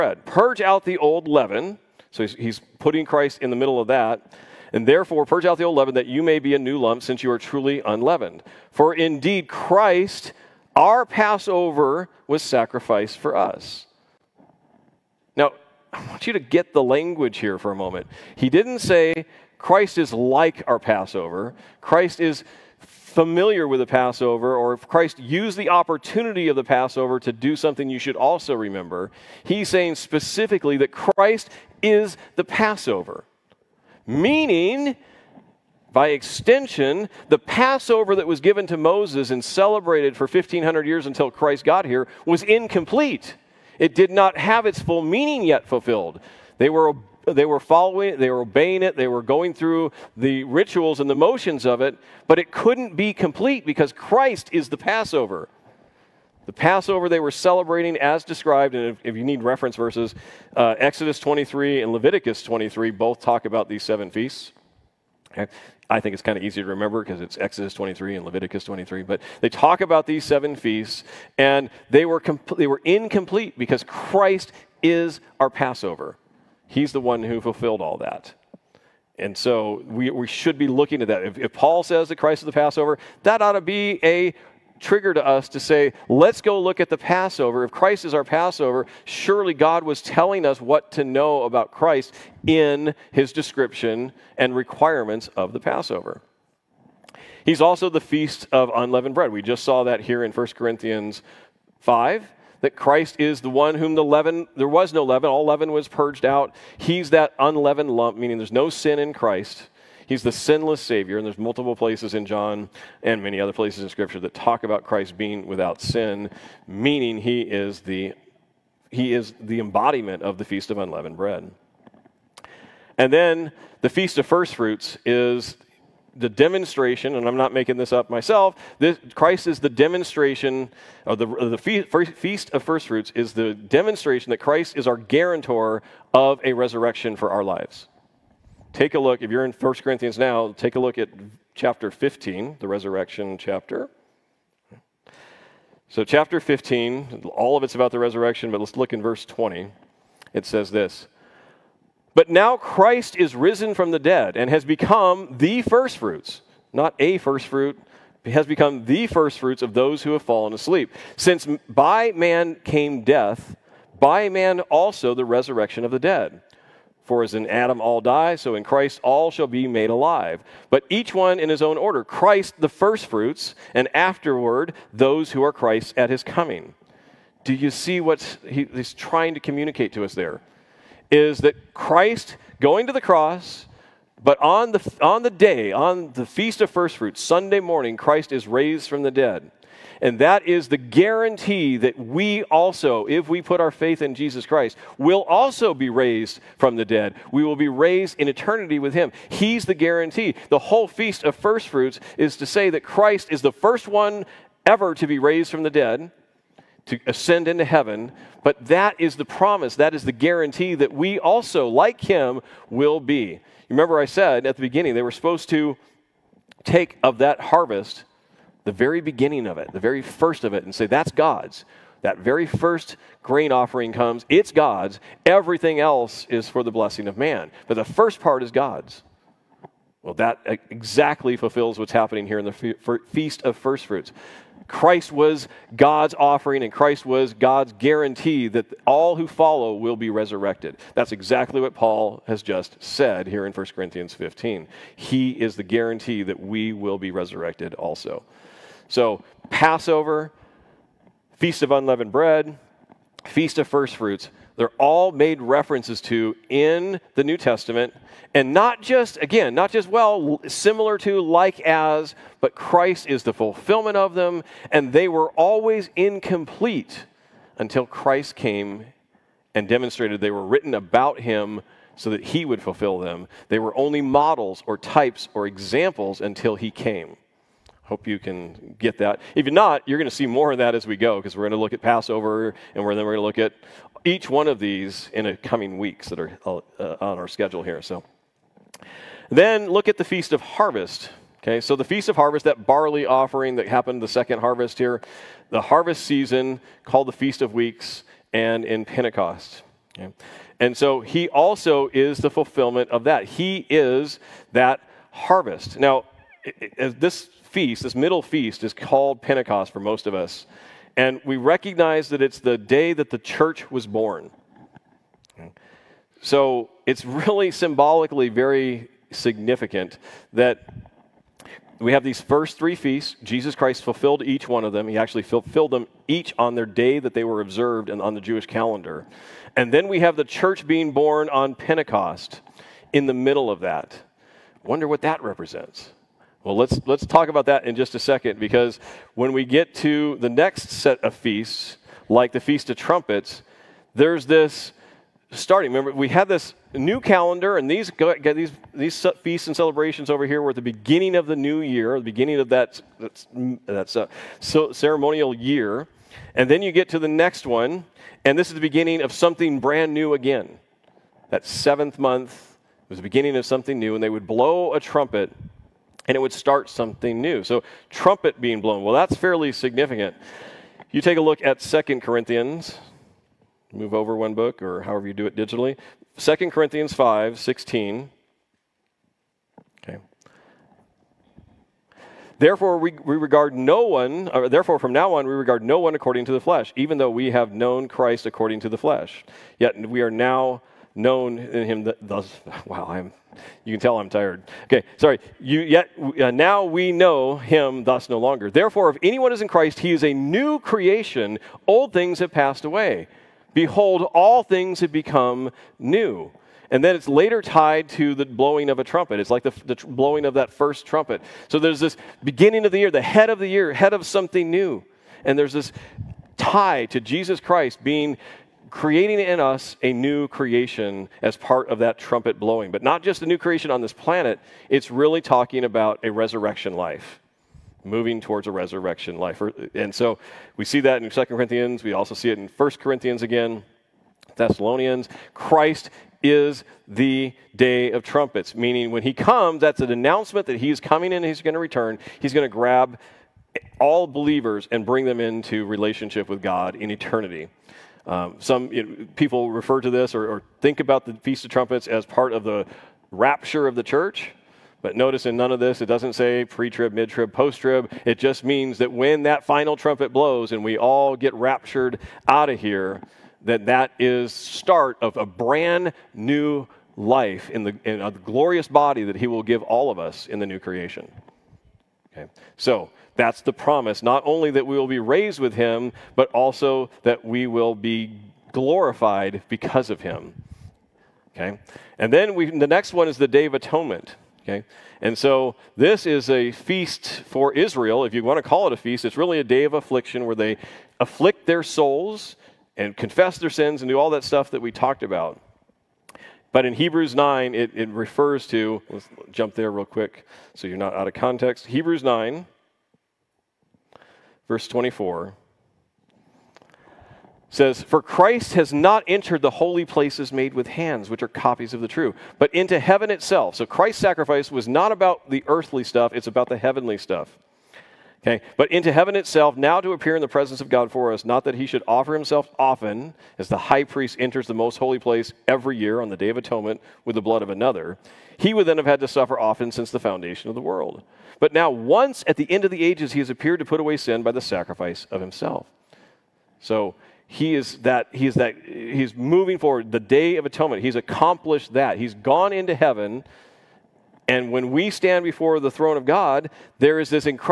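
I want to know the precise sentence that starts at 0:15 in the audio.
I want you to get the language here for a moment.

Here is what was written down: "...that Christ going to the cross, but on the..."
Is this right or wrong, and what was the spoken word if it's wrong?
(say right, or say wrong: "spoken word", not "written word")
right.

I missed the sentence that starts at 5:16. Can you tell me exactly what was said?
So it's really symbolically very significant that we have these first three feasts.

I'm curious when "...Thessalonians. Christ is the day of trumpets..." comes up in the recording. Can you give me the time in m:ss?
7:14.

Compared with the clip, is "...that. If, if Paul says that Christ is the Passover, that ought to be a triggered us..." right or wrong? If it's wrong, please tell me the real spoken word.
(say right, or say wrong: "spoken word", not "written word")
right.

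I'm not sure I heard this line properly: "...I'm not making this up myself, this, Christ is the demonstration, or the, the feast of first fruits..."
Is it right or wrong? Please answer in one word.
right.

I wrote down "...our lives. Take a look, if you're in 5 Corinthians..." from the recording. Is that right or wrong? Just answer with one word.
wrong.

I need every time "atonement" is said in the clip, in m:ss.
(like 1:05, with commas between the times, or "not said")
8:03, 8:46, 9:00.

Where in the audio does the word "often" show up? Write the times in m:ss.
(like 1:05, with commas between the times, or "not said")
8:42, 8:49.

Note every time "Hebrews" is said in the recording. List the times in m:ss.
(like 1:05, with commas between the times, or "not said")
8:16, 8:21.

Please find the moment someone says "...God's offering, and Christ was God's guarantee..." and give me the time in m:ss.
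3:55.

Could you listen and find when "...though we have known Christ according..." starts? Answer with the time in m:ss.
6:26.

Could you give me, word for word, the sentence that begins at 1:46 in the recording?
He's that unleavened lump, meaning there's no sin in Christ.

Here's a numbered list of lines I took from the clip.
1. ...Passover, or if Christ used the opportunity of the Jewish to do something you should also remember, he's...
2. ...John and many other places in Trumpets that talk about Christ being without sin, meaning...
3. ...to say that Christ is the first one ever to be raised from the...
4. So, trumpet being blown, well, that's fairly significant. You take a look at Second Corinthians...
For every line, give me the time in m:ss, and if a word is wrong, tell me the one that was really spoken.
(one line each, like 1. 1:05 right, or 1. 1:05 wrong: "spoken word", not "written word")
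1. 0:23 wrong: "Passover", not "Jewish"
2. 1:52 wrong: "Scripture", not "Trumpets"
3. 3:22 right
4. 6:07 right.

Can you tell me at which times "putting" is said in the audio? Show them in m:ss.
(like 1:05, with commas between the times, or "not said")
0:02.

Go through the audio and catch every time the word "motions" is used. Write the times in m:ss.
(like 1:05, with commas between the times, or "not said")
0:51.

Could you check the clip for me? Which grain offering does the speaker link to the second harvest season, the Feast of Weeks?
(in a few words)
Barley.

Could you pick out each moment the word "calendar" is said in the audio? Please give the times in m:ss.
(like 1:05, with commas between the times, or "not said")
5:28, 5:46.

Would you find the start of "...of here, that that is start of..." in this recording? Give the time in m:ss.
7:42.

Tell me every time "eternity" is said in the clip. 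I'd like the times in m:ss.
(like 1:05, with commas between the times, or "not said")
3:18, 7:26.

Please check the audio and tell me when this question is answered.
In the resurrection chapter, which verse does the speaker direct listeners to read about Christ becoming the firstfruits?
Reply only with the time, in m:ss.
2:29.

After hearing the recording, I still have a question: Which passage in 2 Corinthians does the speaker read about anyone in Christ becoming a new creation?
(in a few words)
2 Corinthians 5:16.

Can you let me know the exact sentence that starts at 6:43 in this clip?
Behold, all things have become new.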